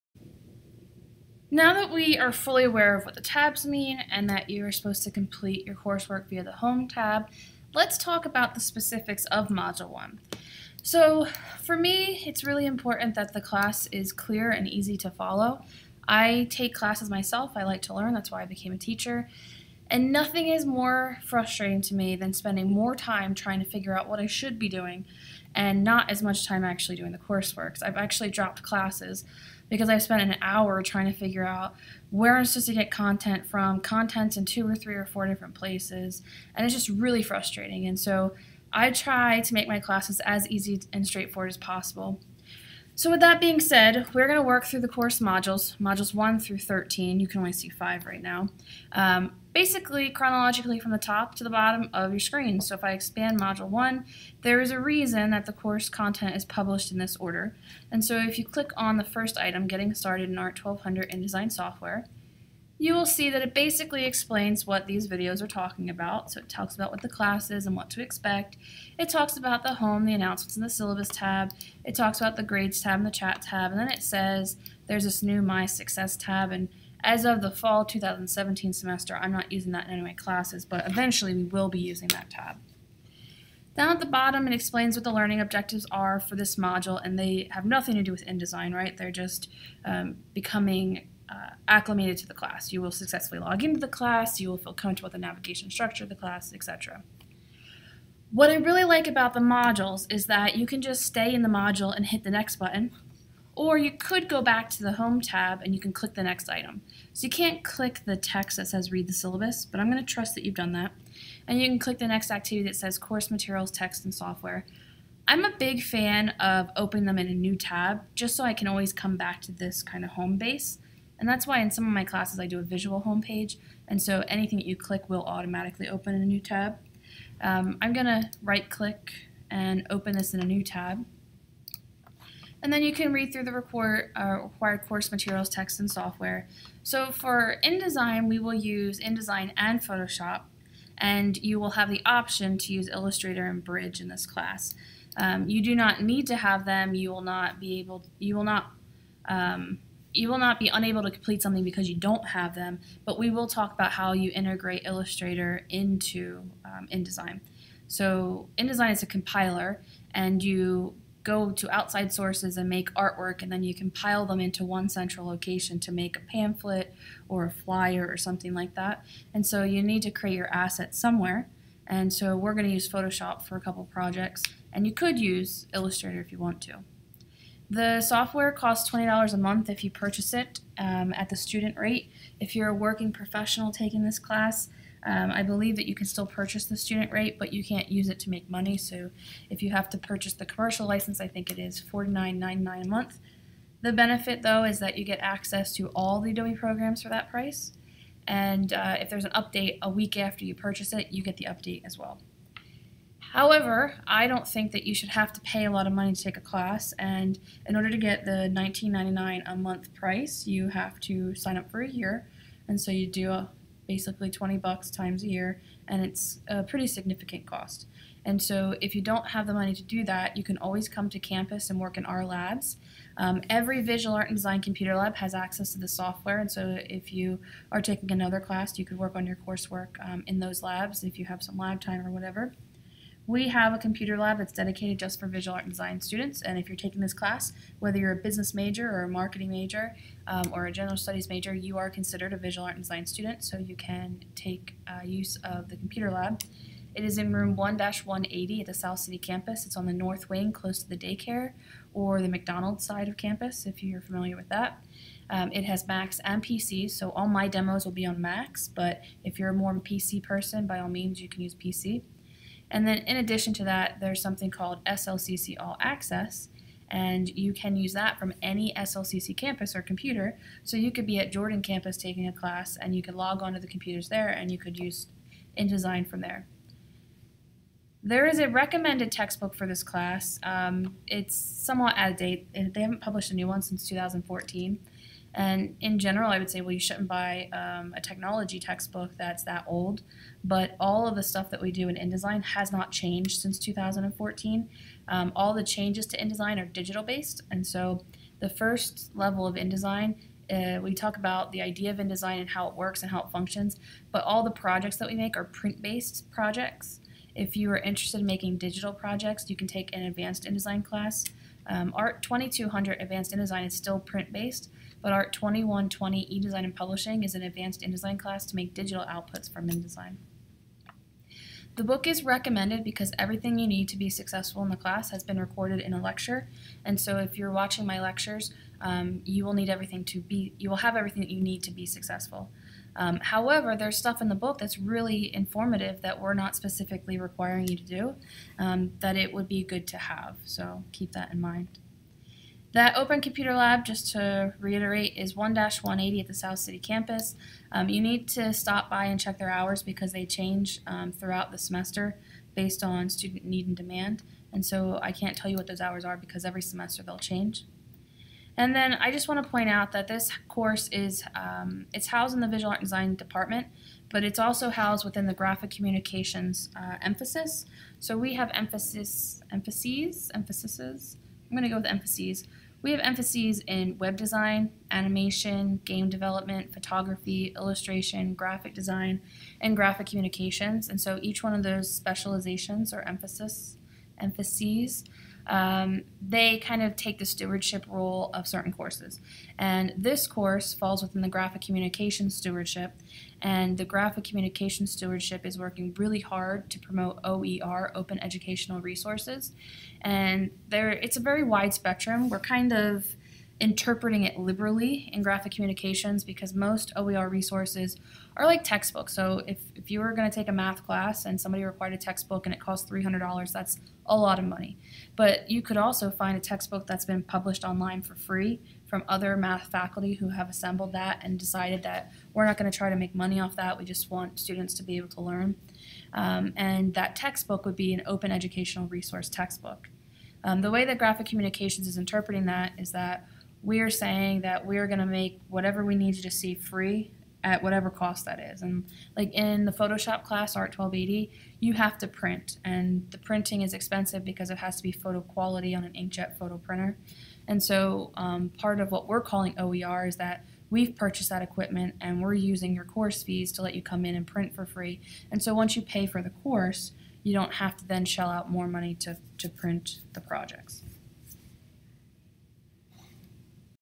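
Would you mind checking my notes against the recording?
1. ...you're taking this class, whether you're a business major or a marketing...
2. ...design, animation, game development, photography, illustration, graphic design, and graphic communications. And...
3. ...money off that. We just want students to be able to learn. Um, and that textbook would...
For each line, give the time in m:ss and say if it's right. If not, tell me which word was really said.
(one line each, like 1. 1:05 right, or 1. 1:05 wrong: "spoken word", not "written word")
1. 3:56 right
2. 6:14 right
3. 7:03 right.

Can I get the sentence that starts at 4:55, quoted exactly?
Um, all the changes to InDesign are digital based.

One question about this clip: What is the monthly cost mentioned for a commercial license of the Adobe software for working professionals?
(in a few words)
$49.99.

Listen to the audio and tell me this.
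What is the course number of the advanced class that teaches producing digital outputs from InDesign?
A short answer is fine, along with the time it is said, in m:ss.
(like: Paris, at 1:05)
ART 2120, at 5:15.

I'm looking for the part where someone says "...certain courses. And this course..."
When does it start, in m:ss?
6:28.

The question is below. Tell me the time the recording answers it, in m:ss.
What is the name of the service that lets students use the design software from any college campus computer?
4:24.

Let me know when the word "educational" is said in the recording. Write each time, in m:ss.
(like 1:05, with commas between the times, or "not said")
6:38, 7:08.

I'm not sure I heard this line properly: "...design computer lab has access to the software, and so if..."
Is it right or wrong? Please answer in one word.
right.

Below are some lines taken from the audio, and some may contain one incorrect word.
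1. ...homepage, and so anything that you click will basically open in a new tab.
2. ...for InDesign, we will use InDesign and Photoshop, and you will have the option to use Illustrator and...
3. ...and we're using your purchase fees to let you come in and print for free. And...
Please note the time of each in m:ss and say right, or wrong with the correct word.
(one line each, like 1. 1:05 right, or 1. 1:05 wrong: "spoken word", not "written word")
1. 2:03 wrong: "automatically", not "basically"
2. 2:17 right
3. 7:31 wrong: "course", not "purchase".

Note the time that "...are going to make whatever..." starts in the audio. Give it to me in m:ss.
7:14.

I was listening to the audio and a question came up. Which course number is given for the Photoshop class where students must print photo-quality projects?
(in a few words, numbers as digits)
Art 1280.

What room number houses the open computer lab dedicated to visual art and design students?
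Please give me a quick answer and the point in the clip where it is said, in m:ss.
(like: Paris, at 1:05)
1-180, at 5:45.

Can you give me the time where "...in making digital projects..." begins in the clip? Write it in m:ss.
5:08.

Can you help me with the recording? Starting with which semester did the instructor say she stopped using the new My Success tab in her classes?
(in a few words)
fall 2017.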